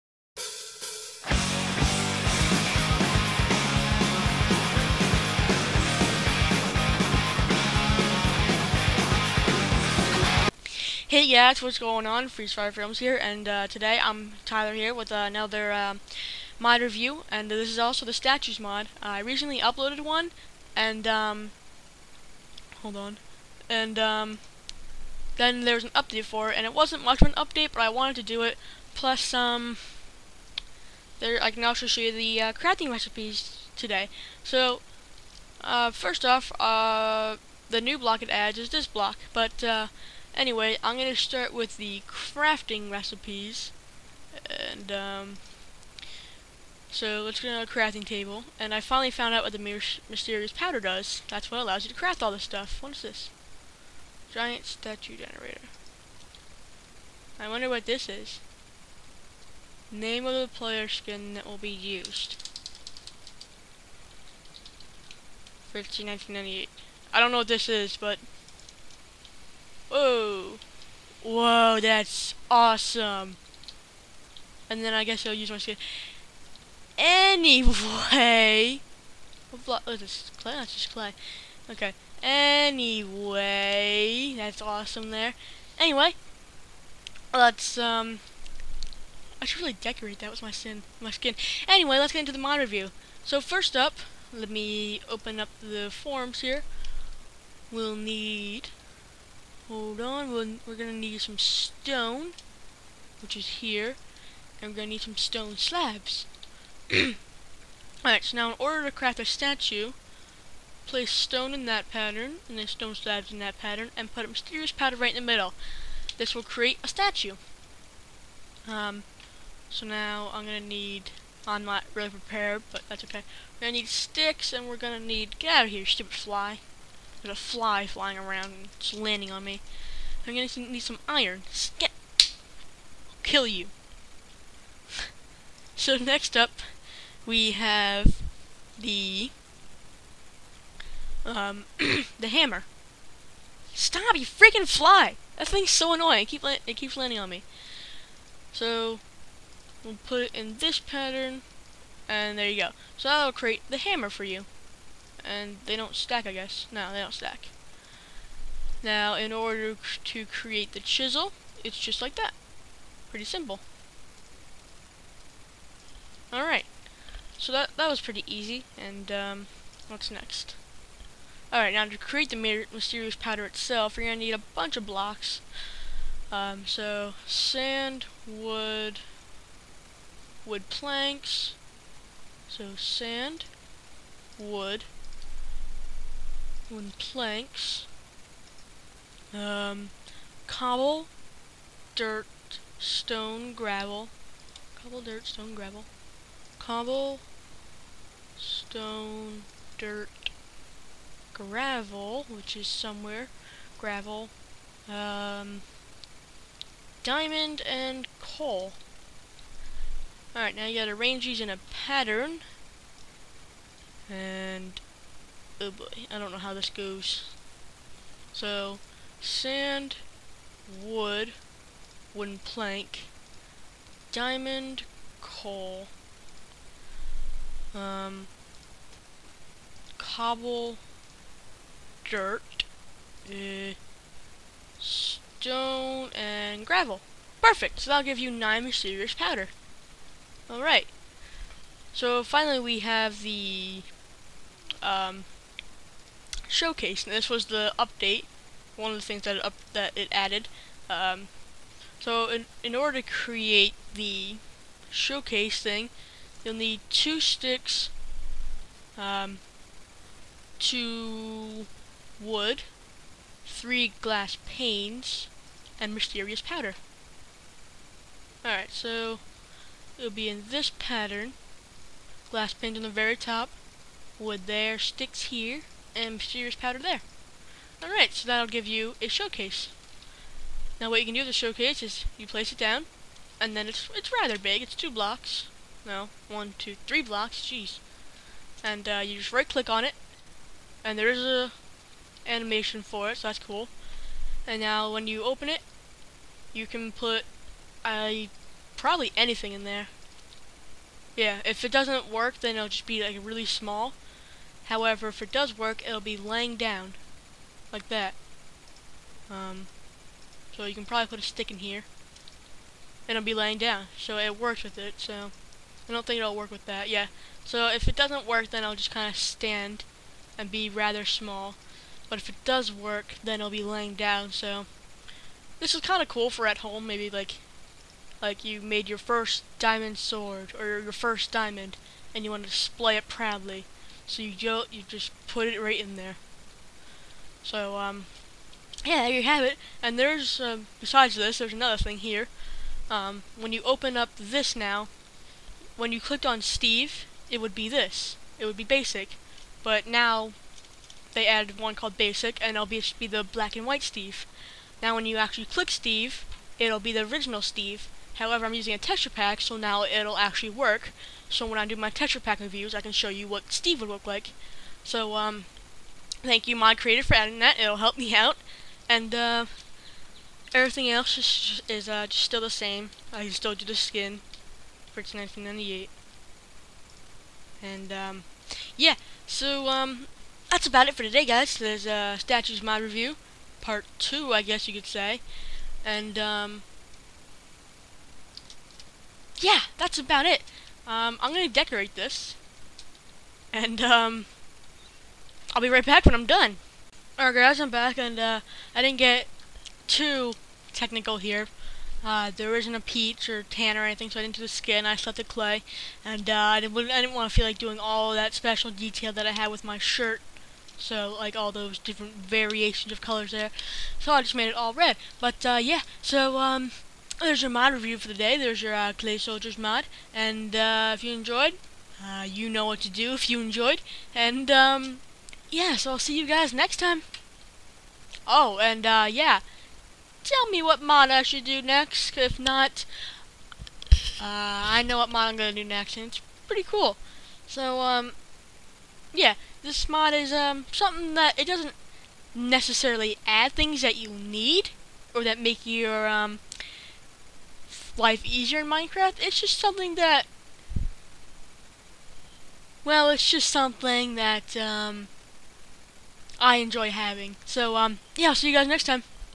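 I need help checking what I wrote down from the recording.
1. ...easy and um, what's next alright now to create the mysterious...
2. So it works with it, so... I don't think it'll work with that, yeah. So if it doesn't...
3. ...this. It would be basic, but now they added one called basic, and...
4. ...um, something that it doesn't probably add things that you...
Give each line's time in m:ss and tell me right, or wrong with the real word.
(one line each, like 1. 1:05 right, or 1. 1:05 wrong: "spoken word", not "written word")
1. 2:48 right
2. 5:13 right
3. 5:47 right
4. 7:20 wrong: "necessarily", not "probably".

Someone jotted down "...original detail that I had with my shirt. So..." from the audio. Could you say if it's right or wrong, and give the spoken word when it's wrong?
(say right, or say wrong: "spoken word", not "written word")
wrong: "special", not "original".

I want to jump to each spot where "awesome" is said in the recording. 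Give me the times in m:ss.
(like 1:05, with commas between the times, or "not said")
1:12, 1:24.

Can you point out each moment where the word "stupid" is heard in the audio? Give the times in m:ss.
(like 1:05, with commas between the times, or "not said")
2:05.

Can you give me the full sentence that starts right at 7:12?
If not, uh, I know what mod I'm going to do next, and it's pretty cool.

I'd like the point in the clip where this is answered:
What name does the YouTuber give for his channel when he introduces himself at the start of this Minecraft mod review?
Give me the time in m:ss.
0:12.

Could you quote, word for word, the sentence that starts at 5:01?
Yeah, if it doesn't work, then it'll just be like really small.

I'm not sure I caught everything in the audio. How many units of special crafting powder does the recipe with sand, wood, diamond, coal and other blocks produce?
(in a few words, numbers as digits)
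9.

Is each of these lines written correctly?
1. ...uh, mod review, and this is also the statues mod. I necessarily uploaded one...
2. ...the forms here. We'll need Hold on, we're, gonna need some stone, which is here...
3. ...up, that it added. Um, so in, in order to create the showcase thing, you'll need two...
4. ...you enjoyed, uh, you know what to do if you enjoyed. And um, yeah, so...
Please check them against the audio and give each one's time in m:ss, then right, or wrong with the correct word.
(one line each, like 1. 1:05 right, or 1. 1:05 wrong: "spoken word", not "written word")
1. 0:15 wrong: "recently", not "necessarily"
2. 1:35 right
3. 4:09 right
4. 7:01 right.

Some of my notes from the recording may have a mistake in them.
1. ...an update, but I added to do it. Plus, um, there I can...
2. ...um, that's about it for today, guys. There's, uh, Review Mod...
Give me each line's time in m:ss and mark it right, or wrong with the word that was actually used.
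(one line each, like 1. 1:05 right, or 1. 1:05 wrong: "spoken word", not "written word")
1. 0:27 wrong: "wanted", not "added"
2. 6:19 wrong: "Statues", not "Review".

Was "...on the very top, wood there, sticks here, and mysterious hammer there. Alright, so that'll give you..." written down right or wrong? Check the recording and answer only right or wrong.
wrong.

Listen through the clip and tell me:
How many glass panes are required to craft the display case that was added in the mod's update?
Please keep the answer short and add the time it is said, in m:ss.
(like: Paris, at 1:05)
3, at 4:23.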